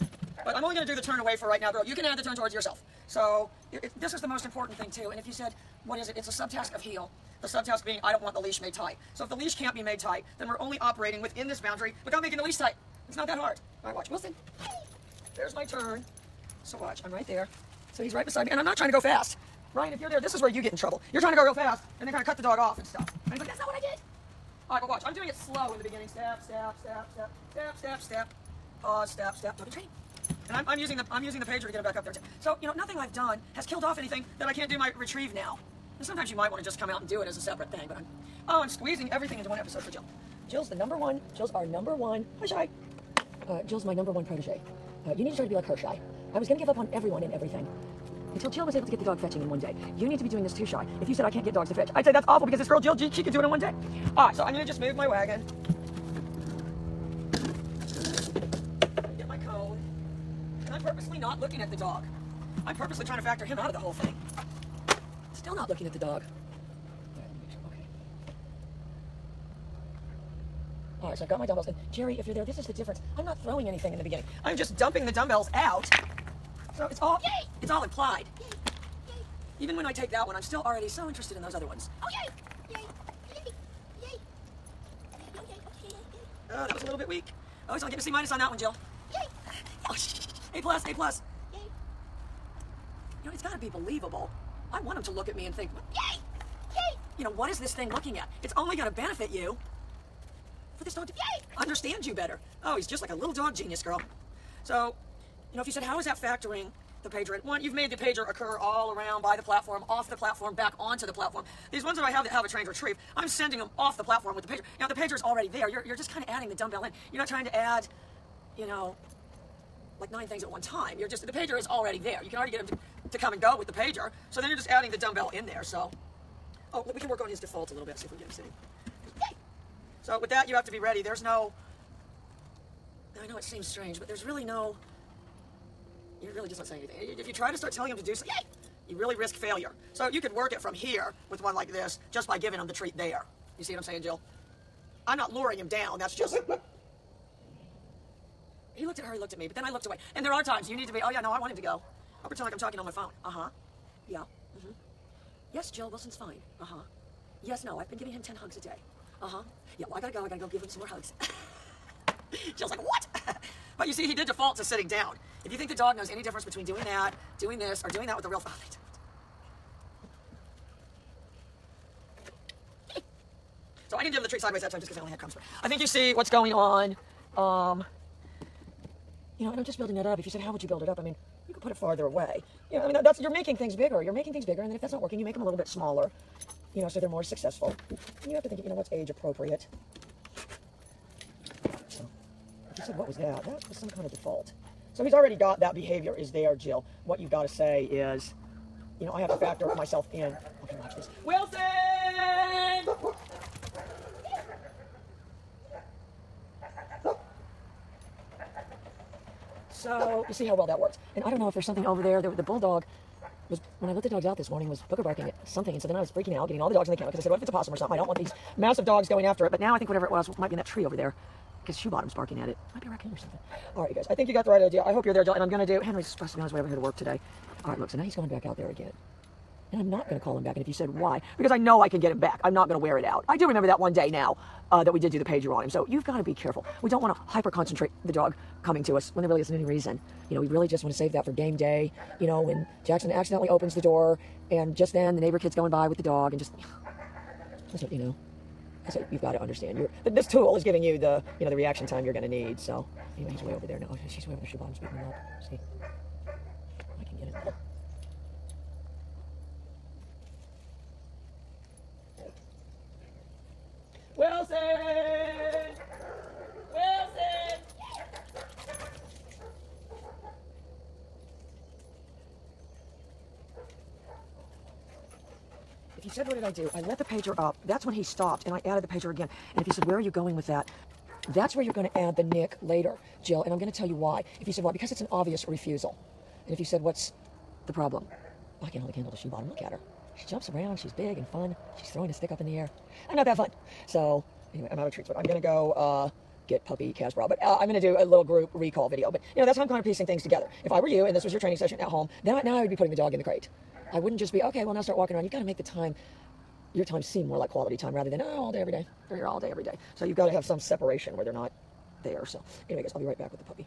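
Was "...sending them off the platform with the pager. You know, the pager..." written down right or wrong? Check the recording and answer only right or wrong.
right.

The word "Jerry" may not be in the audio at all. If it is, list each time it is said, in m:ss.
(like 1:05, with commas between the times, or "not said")
1:11.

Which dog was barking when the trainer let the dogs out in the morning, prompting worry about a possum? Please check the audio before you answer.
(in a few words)
Booker.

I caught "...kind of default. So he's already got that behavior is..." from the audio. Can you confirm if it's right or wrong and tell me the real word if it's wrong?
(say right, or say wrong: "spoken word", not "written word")
right.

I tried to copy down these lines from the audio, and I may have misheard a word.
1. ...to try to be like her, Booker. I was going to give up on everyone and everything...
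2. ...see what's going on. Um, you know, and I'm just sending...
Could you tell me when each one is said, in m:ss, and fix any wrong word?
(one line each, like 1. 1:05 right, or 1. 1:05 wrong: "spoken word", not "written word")
1. 0:45 wrong: "Shy", not "Booker"
2. 2:55 wrong: "building", not "sending".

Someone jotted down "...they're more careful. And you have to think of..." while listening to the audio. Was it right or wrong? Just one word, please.
wrong.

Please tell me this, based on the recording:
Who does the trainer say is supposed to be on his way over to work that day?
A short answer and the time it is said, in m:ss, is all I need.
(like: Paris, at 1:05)
Henry, at 3:45.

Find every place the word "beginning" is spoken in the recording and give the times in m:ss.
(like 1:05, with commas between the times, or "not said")
0:25, 1:14.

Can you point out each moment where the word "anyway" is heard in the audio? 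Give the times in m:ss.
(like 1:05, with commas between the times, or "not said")
4:13, 4:54, 5:12.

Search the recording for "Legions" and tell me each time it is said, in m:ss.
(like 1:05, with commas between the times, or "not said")
not said.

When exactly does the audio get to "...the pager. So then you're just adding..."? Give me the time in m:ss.
2:03.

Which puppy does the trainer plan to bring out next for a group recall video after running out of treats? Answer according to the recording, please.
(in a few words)
Casper.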